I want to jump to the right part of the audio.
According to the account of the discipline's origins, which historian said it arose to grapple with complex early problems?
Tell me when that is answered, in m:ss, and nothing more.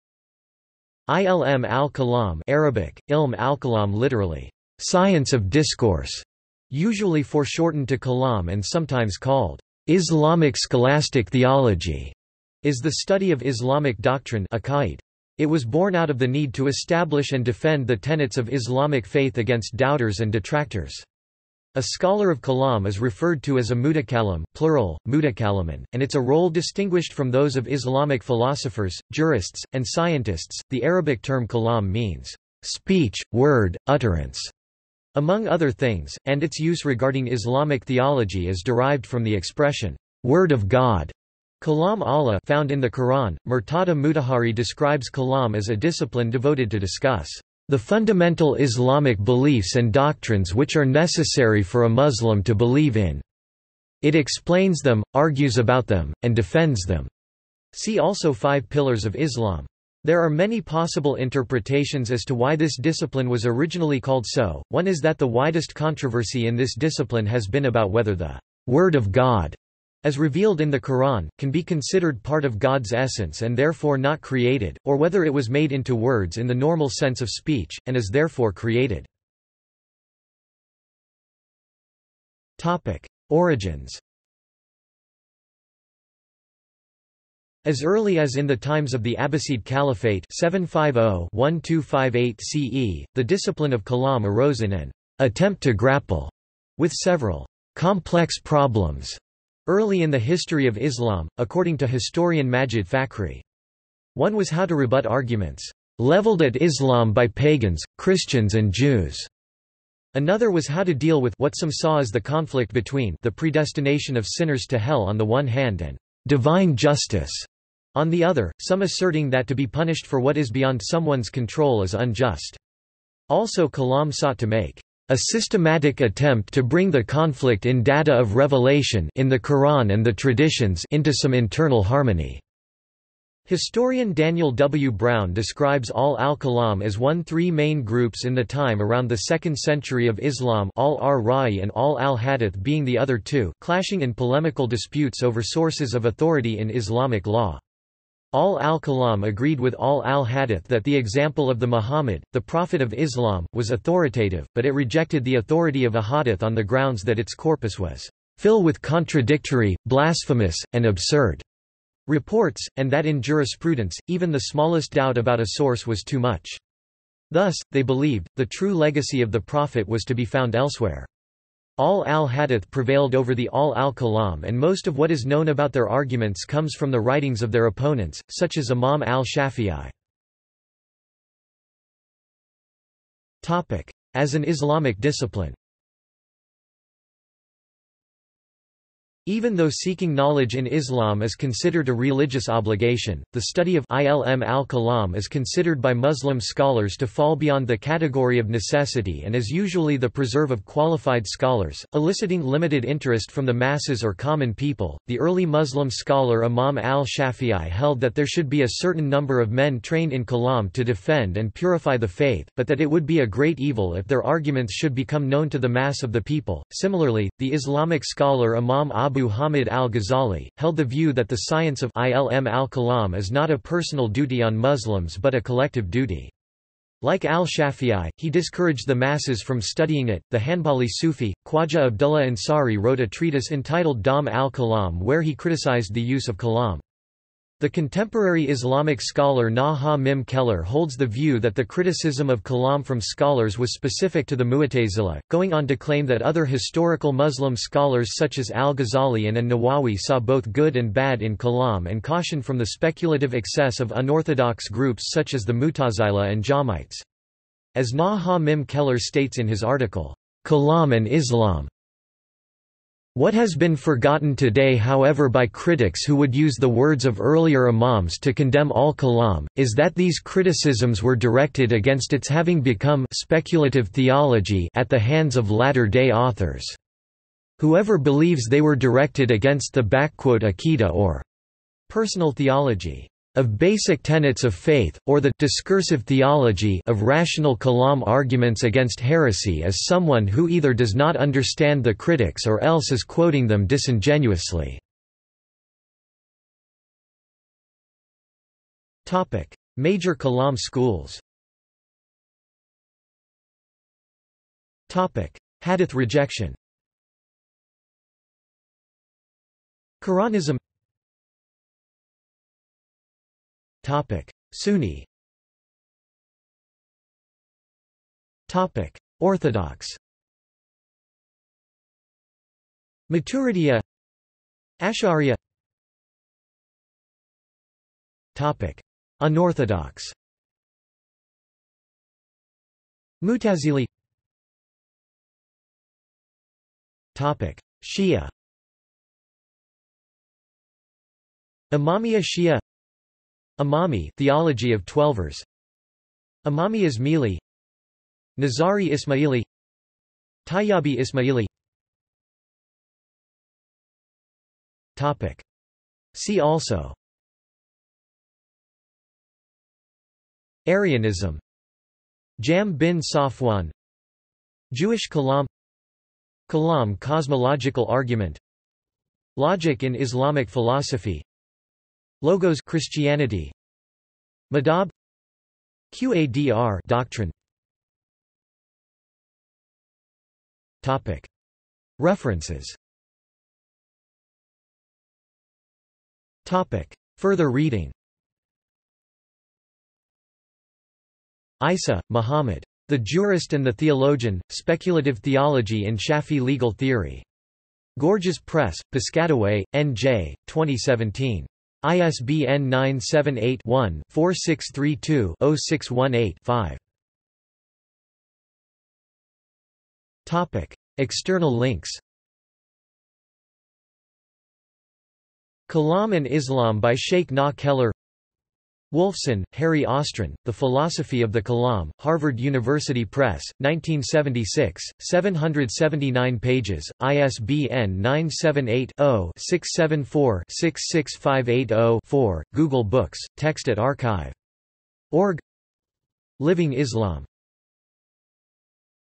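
1:42.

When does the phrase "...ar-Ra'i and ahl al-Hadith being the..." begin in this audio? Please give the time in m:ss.
2:21.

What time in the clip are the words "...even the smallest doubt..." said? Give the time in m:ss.
2:44.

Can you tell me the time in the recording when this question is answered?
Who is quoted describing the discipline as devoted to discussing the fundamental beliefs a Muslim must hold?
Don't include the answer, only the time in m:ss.
0:43.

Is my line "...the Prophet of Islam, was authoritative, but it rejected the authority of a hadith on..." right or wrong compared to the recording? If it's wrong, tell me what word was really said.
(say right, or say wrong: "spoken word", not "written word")
right.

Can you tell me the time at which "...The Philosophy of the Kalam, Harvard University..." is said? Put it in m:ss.
7:00.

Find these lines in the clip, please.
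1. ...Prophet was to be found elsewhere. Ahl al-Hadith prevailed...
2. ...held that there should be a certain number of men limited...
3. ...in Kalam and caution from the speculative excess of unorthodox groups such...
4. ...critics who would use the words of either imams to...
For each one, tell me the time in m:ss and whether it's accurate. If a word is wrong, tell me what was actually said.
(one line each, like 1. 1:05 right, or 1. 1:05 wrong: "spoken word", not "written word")
1. 2:49 right
2. 3:27 wrong: "trained", not "limited"
3. 4:11 right
4. 4:25 wrong: "earlier", not "either".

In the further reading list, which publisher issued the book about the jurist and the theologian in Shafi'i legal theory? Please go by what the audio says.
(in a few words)
Gorgias Press.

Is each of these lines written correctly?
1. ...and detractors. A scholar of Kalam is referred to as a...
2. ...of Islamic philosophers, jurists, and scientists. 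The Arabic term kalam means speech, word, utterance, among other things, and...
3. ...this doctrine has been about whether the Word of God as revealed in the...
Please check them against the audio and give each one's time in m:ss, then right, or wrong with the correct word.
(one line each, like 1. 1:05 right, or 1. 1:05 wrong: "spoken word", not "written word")
1. 0:20 right
2. 0:27 right
3. 1:06 wrong: "discipline", not "doctrine".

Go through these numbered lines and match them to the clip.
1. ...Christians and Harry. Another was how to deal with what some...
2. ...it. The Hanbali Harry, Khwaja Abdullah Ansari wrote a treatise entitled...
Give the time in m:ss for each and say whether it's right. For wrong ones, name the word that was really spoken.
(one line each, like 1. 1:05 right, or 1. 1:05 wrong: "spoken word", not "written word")
1. 1:47 wrong: "Jews", not "Harry"
2. 3:50 wrong: "Sufi", not "Harry".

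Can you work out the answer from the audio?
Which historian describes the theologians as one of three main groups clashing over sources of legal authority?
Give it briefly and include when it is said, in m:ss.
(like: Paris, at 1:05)
Daniel W. Brown, at 2:14.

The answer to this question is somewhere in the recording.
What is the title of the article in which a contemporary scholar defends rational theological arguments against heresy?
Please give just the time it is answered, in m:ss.
4:20.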